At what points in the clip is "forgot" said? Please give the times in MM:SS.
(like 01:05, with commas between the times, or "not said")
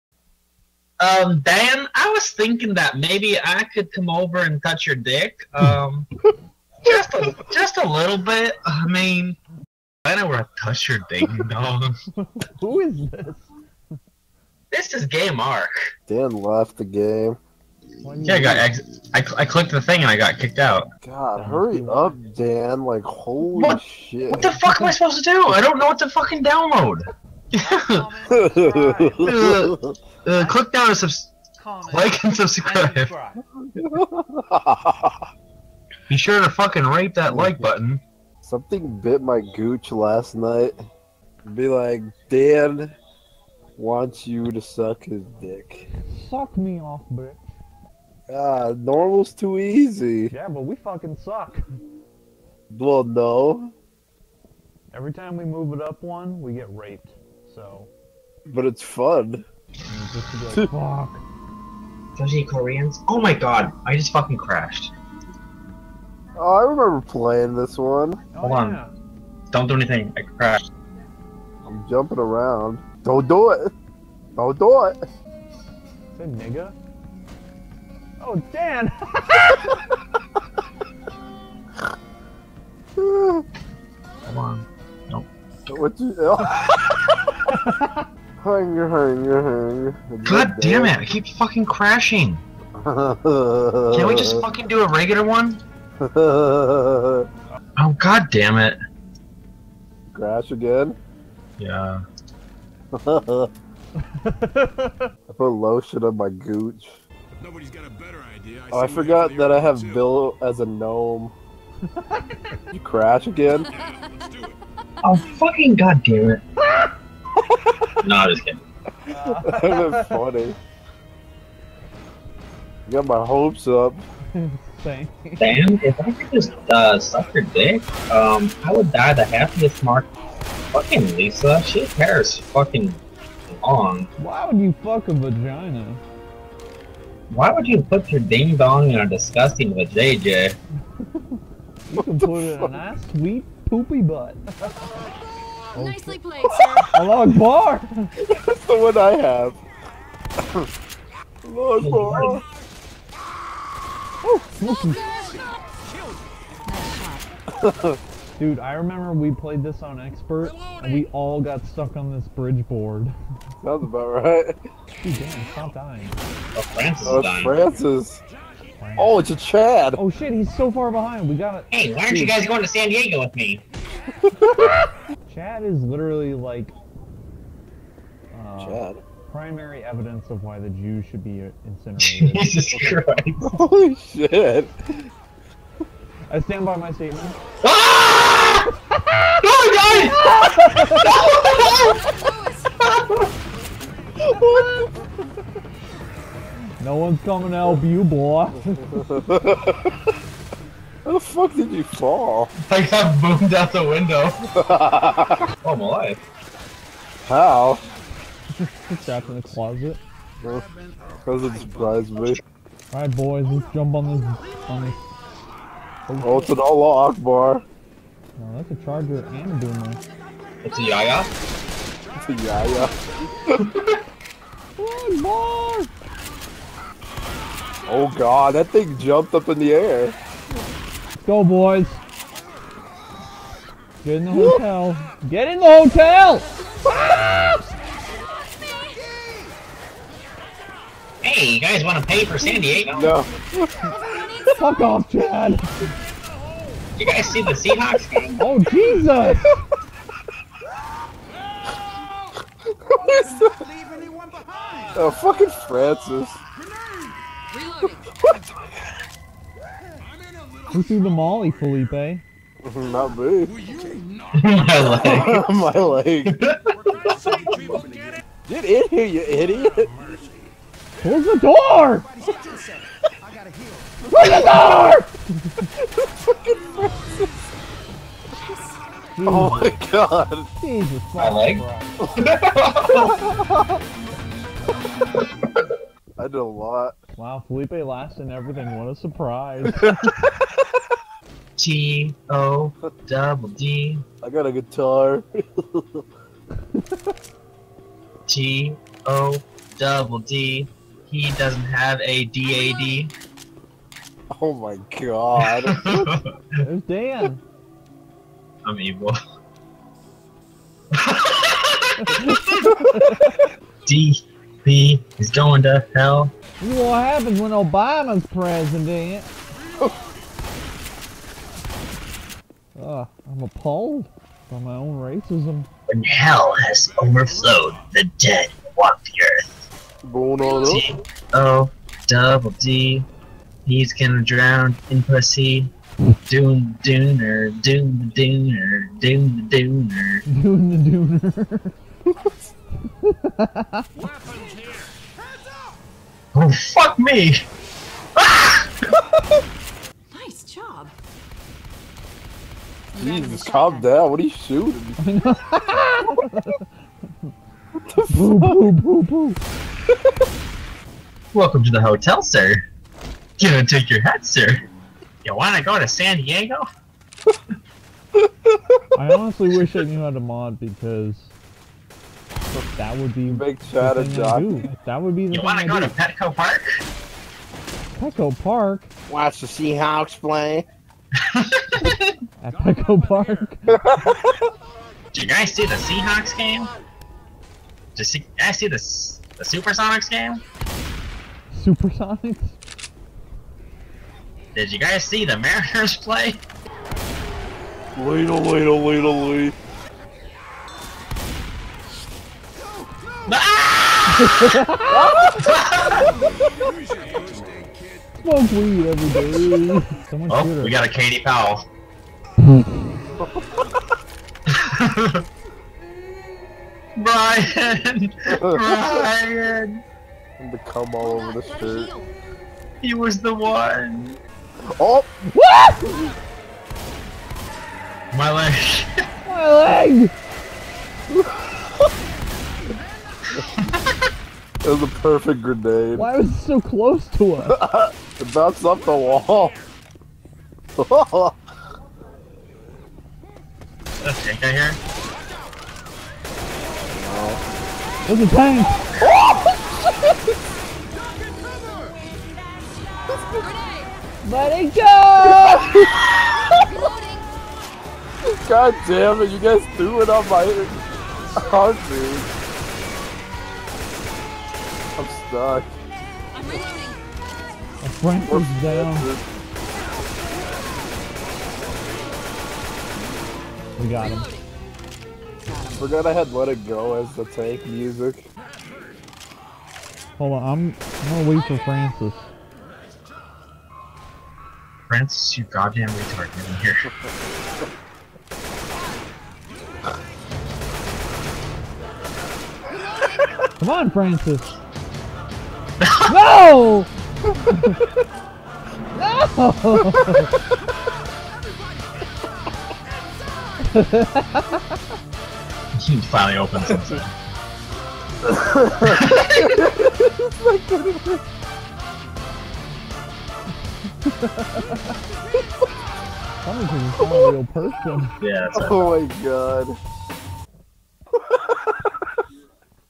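01:48, 07:55.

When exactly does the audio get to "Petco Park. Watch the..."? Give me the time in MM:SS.
06:17.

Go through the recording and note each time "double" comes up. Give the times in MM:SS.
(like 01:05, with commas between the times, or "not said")
04:53, 04:59, 05:32.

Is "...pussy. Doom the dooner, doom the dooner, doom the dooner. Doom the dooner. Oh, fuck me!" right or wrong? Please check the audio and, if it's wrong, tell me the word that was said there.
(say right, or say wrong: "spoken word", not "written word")
right.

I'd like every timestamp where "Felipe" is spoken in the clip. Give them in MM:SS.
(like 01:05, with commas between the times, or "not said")
04:21, 04:47.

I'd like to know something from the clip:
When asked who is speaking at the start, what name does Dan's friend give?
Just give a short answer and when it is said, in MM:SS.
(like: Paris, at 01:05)
Game Arc, at 00:15.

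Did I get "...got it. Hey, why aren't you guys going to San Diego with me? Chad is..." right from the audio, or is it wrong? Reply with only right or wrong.
right.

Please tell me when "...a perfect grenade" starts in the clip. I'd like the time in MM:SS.
07:14.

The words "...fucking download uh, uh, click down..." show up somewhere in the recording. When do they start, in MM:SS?
00:26.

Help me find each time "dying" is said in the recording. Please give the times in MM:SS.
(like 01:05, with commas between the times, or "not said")
02:45.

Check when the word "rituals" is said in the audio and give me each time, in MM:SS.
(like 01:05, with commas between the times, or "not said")
not said.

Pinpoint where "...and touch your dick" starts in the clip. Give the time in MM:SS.
00:04.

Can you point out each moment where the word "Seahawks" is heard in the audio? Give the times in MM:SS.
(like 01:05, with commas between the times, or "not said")
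04:07, 06:19, 06:25.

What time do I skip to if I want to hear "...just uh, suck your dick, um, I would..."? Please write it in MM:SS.
02:06.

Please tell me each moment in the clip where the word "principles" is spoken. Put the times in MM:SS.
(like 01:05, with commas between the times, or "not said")
not said.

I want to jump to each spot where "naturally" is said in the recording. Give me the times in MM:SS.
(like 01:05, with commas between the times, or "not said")
not said.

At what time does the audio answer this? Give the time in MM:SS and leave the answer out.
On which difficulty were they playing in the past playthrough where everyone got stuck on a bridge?
02:40.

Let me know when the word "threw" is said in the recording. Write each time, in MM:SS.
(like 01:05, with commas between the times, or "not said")
04:20, 07:39.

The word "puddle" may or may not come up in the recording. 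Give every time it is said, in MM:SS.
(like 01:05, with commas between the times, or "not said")
not said.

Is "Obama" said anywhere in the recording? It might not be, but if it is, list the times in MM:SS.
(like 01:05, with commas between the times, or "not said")
05:17.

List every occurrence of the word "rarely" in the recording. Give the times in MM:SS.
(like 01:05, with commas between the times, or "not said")
not said.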